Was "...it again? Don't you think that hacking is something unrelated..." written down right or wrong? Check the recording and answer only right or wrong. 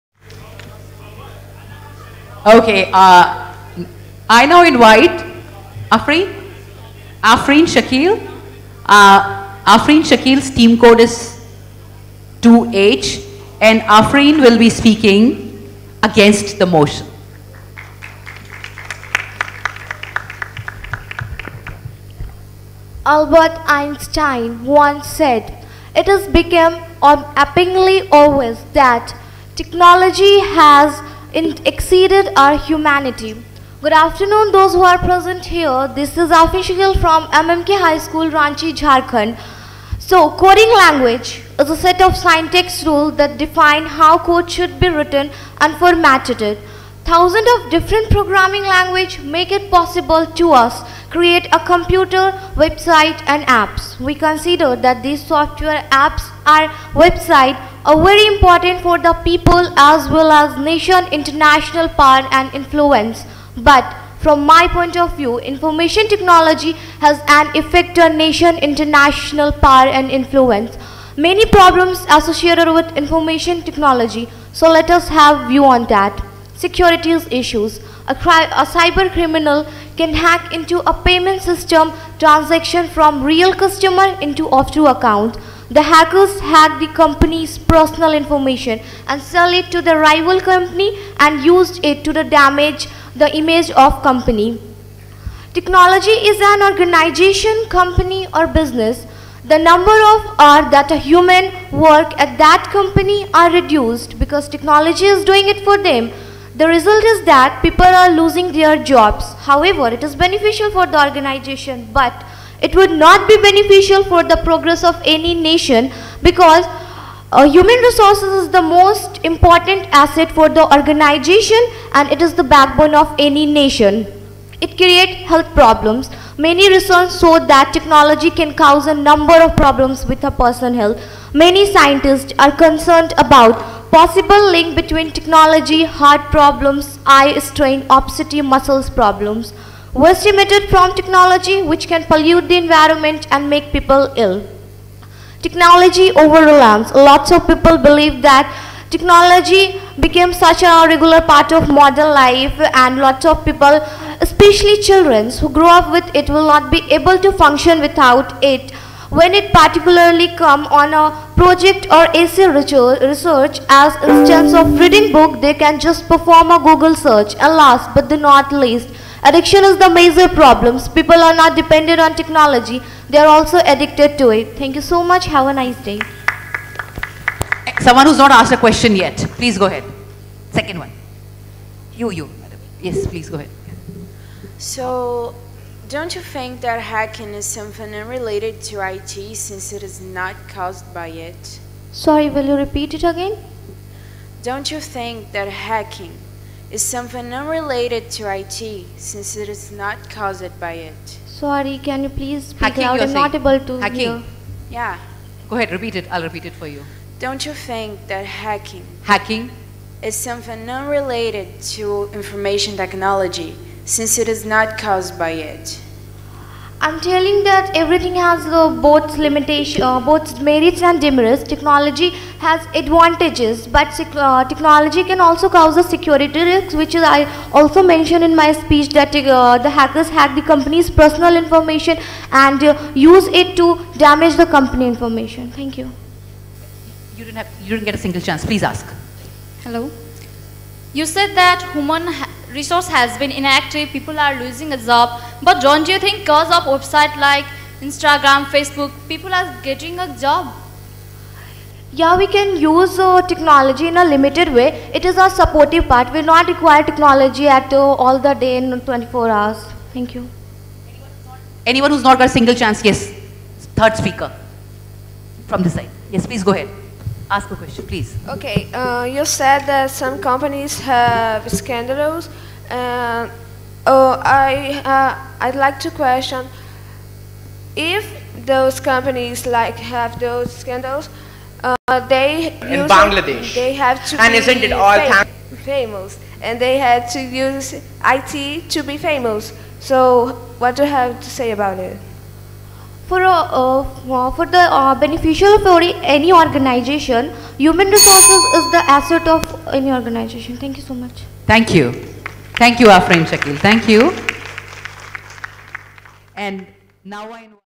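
right.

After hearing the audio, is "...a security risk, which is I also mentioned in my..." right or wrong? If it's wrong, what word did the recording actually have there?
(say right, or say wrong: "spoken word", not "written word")
right.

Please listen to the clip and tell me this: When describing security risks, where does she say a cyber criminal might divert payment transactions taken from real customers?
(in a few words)
offshore account.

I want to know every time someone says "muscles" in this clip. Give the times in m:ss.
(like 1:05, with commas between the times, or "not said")
2:18.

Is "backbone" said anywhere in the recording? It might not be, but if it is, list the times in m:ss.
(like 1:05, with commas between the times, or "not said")
2:02.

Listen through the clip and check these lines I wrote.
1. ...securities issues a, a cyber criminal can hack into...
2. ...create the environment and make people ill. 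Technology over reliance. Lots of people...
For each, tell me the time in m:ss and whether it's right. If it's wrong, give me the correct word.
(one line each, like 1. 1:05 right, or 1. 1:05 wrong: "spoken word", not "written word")
1. 1:16 right
2. 2:22 wrong: "pollute", not "create".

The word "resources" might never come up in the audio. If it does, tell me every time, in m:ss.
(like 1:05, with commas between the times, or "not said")
1:57, 4:02, 4:57.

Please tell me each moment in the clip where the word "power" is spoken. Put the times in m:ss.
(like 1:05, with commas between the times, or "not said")
1:01, 1:09.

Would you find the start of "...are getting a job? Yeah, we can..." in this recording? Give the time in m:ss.
4:09.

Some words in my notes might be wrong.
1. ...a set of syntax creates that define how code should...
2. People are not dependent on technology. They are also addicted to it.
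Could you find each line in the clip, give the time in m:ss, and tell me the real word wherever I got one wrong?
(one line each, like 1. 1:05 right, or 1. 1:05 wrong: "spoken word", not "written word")
1. 0:41 wrong: "rules", not "creates"
2. 2:50 right.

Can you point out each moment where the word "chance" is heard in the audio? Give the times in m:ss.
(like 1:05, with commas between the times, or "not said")
3:58, 4:22.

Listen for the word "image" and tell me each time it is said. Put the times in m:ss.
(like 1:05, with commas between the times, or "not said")
1:33.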